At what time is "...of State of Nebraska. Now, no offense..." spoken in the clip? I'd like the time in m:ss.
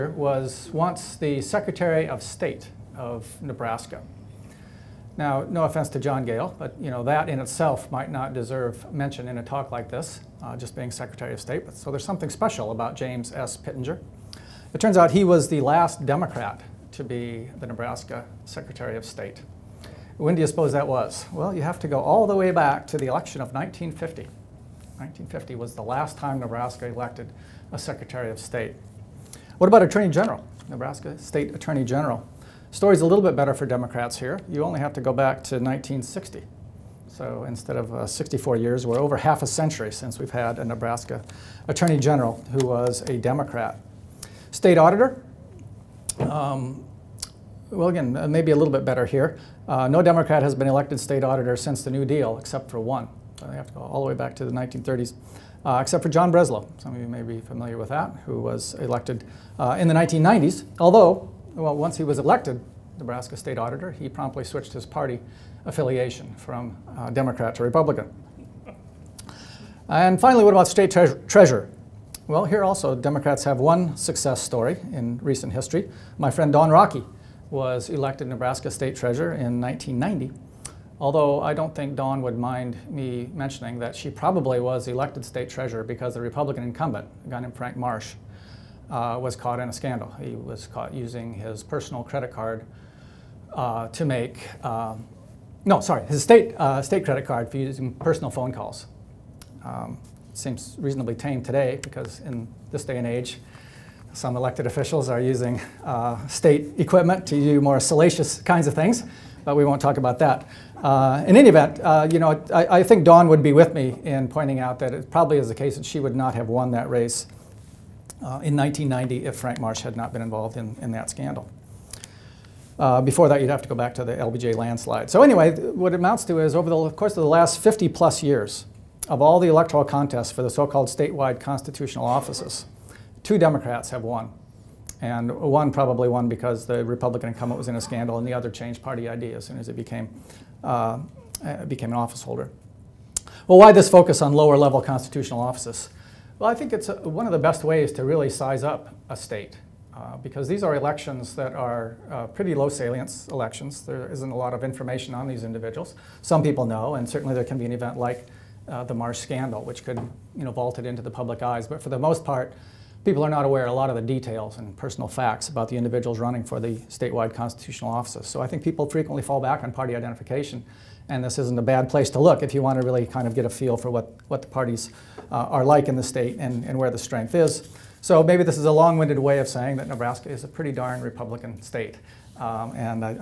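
0:02.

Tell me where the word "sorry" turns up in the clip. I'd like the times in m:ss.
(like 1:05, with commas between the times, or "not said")
1:35.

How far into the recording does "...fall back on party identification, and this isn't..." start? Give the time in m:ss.
2:49.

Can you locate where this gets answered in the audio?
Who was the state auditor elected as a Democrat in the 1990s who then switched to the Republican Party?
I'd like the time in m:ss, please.
0:56.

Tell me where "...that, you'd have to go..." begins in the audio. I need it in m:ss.
2:03.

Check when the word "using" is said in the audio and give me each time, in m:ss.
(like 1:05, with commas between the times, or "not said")
1:30, 1:37, 1:45.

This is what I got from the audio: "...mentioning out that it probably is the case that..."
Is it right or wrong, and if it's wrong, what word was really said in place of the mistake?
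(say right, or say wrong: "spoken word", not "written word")
wrong: "pointing", not "mentioning".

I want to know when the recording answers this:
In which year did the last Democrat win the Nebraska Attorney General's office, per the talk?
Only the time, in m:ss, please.
0:35.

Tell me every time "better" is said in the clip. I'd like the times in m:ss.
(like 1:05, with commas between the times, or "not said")
0:33, 0:48.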